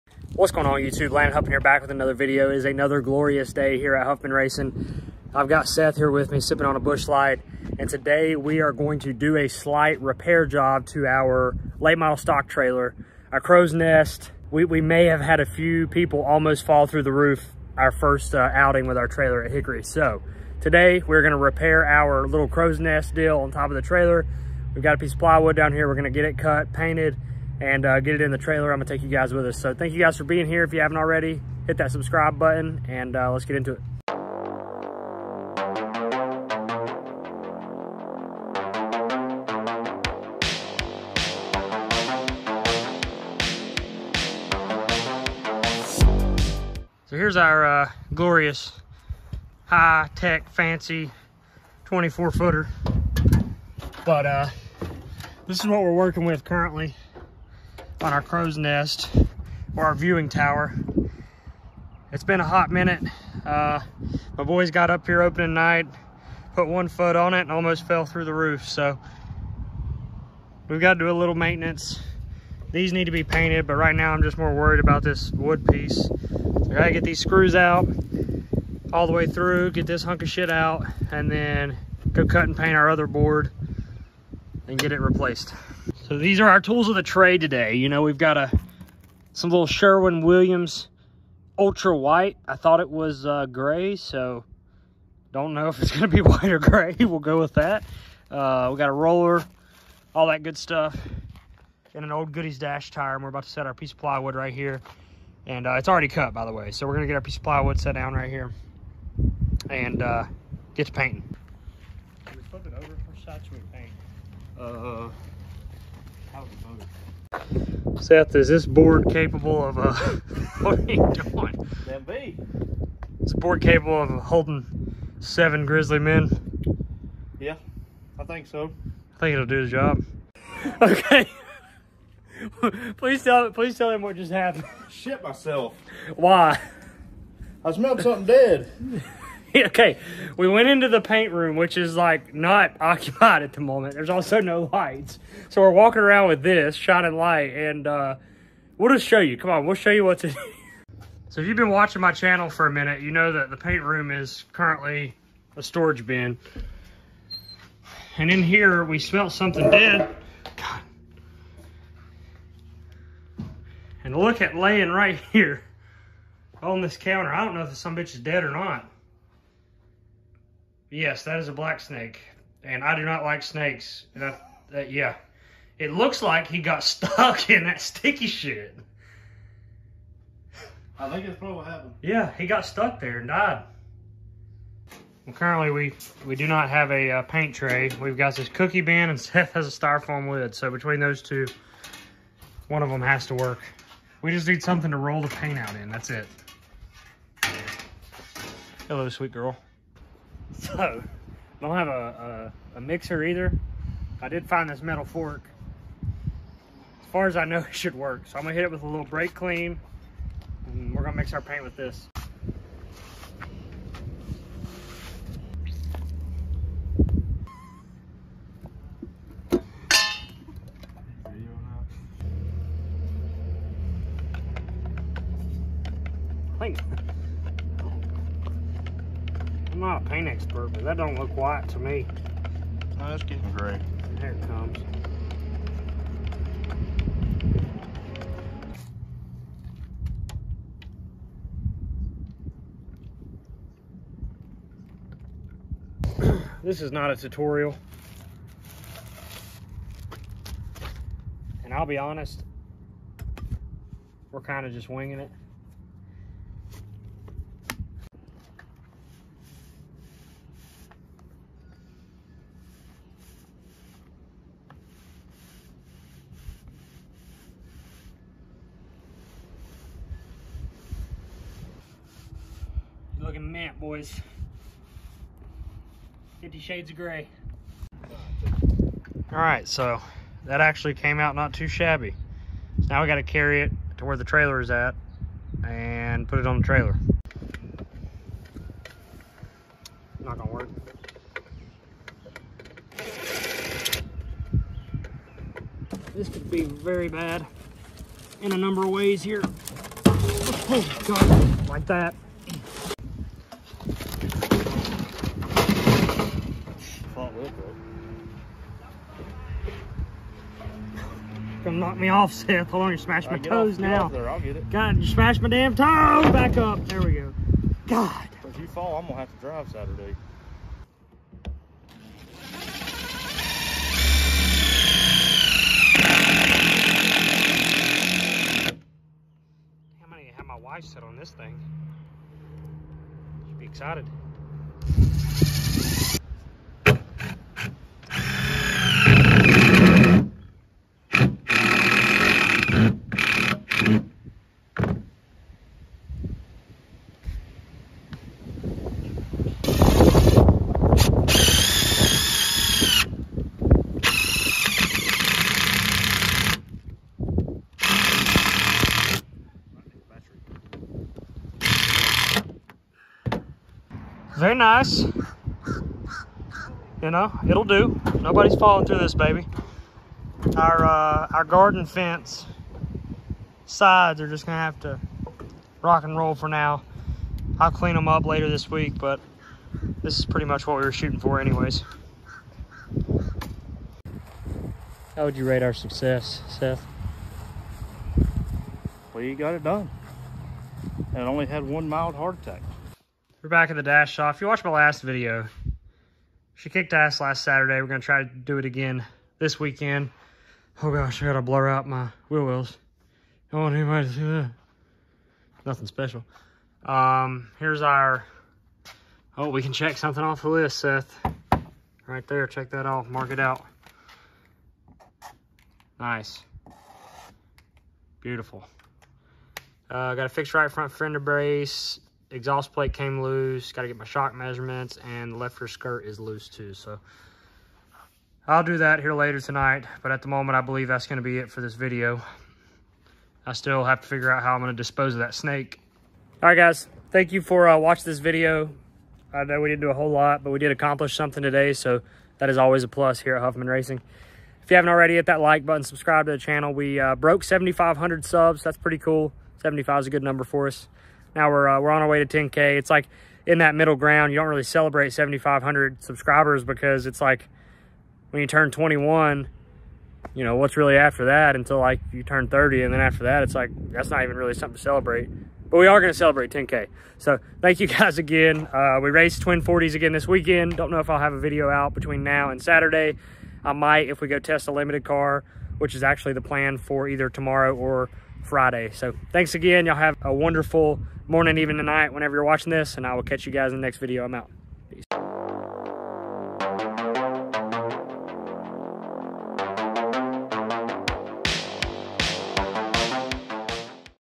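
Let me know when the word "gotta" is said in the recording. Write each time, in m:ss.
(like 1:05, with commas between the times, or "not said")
1:16, 4:43.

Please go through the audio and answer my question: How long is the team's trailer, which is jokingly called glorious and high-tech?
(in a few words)
24 footer.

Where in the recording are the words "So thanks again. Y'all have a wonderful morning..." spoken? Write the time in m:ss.
7:58.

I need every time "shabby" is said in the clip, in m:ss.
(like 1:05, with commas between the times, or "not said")
4:41.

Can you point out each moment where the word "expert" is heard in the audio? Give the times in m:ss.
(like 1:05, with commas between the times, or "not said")
3:50.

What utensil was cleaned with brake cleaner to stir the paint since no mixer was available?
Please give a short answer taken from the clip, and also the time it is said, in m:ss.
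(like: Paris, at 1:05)
metal fork, at 3:24.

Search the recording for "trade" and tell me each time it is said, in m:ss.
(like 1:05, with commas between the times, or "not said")
1:27.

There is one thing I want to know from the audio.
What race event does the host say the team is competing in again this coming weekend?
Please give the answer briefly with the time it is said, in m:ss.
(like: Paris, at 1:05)
Twin 40s, at 7:49.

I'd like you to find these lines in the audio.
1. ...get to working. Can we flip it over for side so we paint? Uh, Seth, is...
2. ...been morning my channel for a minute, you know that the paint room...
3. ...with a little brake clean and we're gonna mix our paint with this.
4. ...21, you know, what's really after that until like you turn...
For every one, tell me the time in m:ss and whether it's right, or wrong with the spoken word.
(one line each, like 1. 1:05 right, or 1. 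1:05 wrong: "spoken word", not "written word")
1. 1:50 wrong: "painting", not "working"
2. 2:31 wrong: "watching", not "morning"
3. 3:28 right
4. 7:38 right.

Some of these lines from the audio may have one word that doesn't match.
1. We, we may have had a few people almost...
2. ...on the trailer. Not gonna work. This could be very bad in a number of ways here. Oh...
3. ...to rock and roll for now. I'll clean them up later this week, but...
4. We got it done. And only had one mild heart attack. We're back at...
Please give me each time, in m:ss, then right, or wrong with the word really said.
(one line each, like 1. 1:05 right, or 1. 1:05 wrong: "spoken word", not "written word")
1. 0:14 right
2. 4:46 right
3. 6:14 right
4. 6:29 right.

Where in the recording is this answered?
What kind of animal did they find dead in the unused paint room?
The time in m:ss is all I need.
2:51.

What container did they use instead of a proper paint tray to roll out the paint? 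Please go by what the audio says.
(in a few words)
cookie bin.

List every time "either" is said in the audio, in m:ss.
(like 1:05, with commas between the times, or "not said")
3:23, 7:57.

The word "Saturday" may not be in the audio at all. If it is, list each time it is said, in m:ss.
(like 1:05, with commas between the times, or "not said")
5:19, 6:37, 7:52.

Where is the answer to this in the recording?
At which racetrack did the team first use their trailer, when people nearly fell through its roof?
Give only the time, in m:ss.
0:19.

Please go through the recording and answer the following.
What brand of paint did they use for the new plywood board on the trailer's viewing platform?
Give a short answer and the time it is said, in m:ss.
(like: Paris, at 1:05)
Sherwin Williams, at 1:29.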